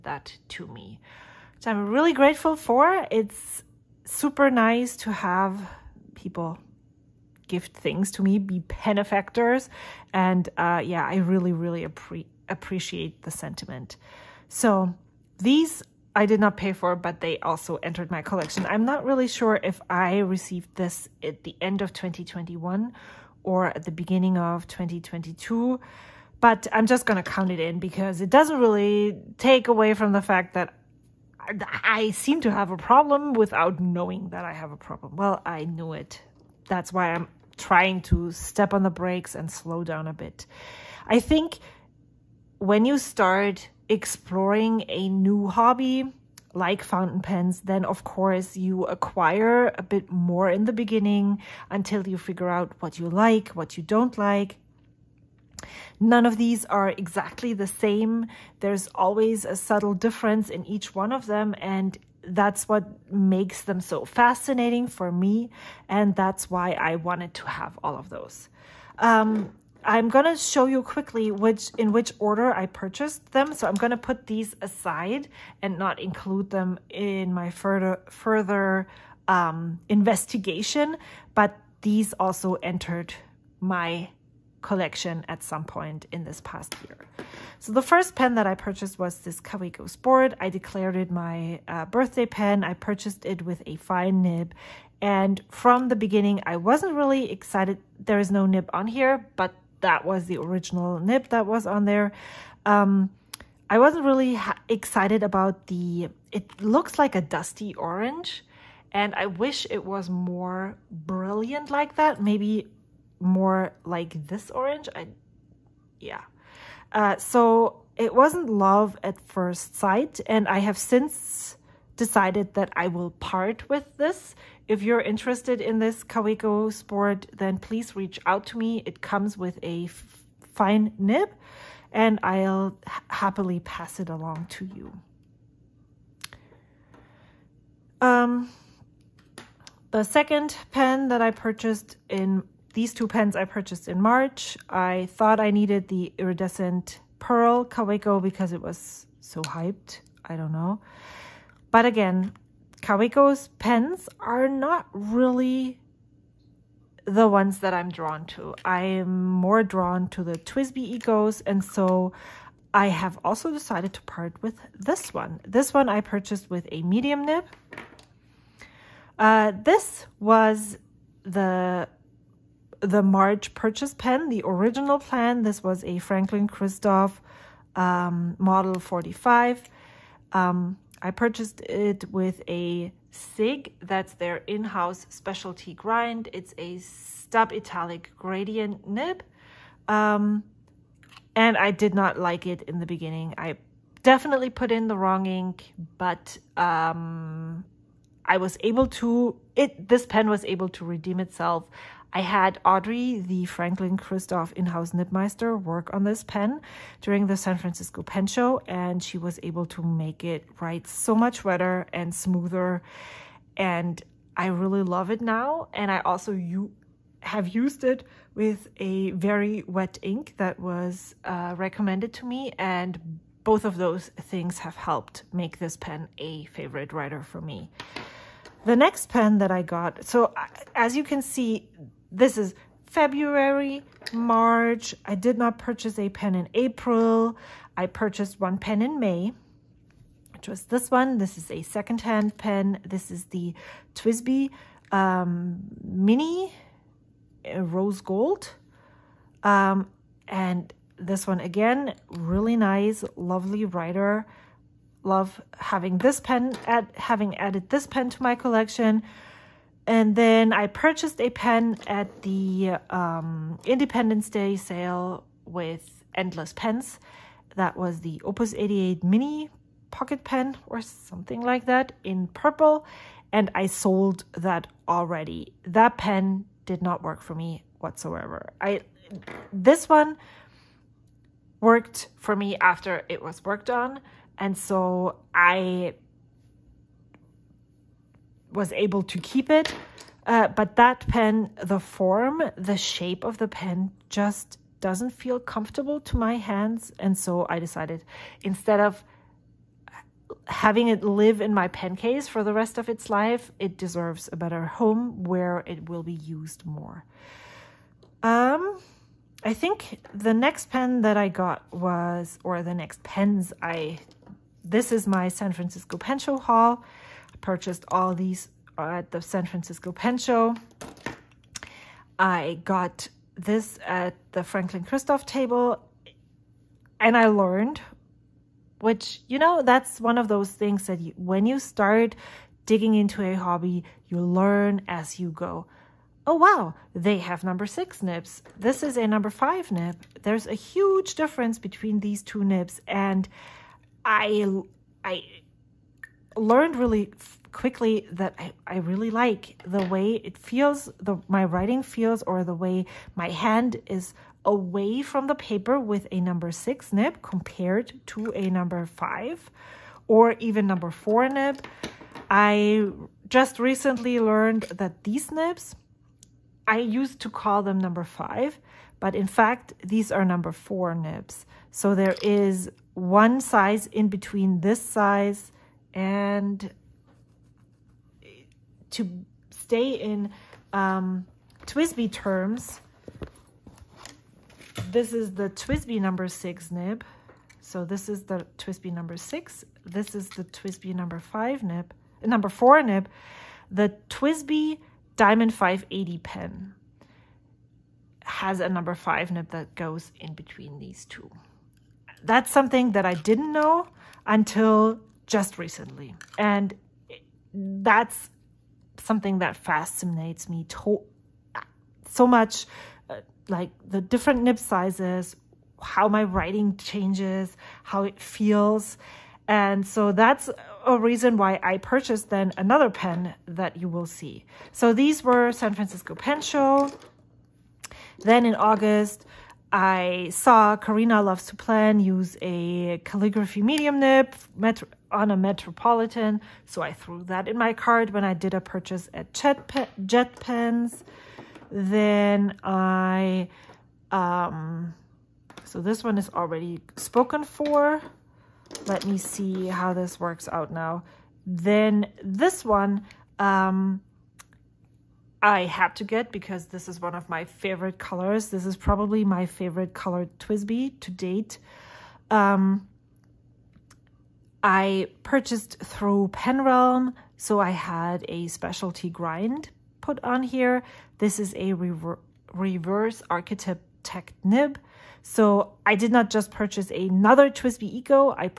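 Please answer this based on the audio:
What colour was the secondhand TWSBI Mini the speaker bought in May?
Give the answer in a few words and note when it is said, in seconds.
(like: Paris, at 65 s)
Rose Gold, at 247 s.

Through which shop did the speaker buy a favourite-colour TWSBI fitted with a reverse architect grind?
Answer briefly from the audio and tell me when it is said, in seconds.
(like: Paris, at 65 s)
Penrealm, at 466 s.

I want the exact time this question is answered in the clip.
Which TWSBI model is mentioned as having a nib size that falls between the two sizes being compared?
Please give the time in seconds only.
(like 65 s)
395 s.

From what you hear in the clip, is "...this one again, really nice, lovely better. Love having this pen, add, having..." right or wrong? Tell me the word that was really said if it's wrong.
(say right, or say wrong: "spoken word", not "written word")
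wrong: "writer", not "better".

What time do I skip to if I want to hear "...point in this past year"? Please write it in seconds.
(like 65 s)
85 s.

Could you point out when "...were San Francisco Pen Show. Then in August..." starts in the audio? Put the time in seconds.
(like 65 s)
425 s.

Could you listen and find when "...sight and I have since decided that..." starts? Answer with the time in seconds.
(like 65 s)
119 s.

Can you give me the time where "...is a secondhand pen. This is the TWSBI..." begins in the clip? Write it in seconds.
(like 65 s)
241 s.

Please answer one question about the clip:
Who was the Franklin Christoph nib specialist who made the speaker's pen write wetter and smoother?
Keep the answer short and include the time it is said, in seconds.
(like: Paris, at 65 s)
Audrey, at 202 s.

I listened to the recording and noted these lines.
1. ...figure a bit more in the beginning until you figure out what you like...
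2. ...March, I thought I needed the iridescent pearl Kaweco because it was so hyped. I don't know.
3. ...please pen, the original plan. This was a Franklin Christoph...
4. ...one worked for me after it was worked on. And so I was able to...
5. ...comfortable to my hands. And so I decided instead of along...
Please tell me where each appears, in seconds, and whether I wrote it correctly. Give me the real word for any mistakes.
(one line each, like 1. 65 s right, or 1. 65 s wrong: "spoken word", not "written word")
1. 48 s wrong: "acquire", not "figure"
2. 144 s right
3. 173 s wrong: "purchase", not "please"
4. 279 s right
5. 295 s wrong: "having", not "along".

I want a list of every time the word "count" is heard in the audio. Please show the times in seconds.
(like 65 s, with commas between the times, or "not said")
27 s.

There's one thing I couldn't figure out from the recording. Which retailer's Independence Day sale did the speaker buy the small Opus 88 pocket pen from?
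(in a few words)
Endless Pens.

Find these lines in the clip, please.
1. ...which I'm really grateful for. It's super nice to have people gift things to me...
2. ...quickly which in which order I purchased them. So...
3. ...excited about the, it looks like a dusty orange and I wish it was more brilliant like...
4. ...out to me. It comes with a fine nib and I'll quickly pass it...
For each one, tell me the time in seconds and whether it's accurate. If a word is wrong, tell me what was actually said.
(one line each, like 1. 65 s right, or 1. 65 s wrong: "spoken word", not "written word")
1. 1 s right
2. 70 s right
3. 104 s right
4. 128 s wrong: "happily", not "quickly".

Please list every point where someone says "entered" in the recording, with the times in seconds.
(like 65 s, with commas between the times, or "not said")
17 s, 82 s.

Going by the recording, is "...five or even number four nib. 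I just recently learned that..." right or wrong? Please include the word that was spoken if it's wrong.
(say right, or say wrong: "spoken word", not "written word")
right.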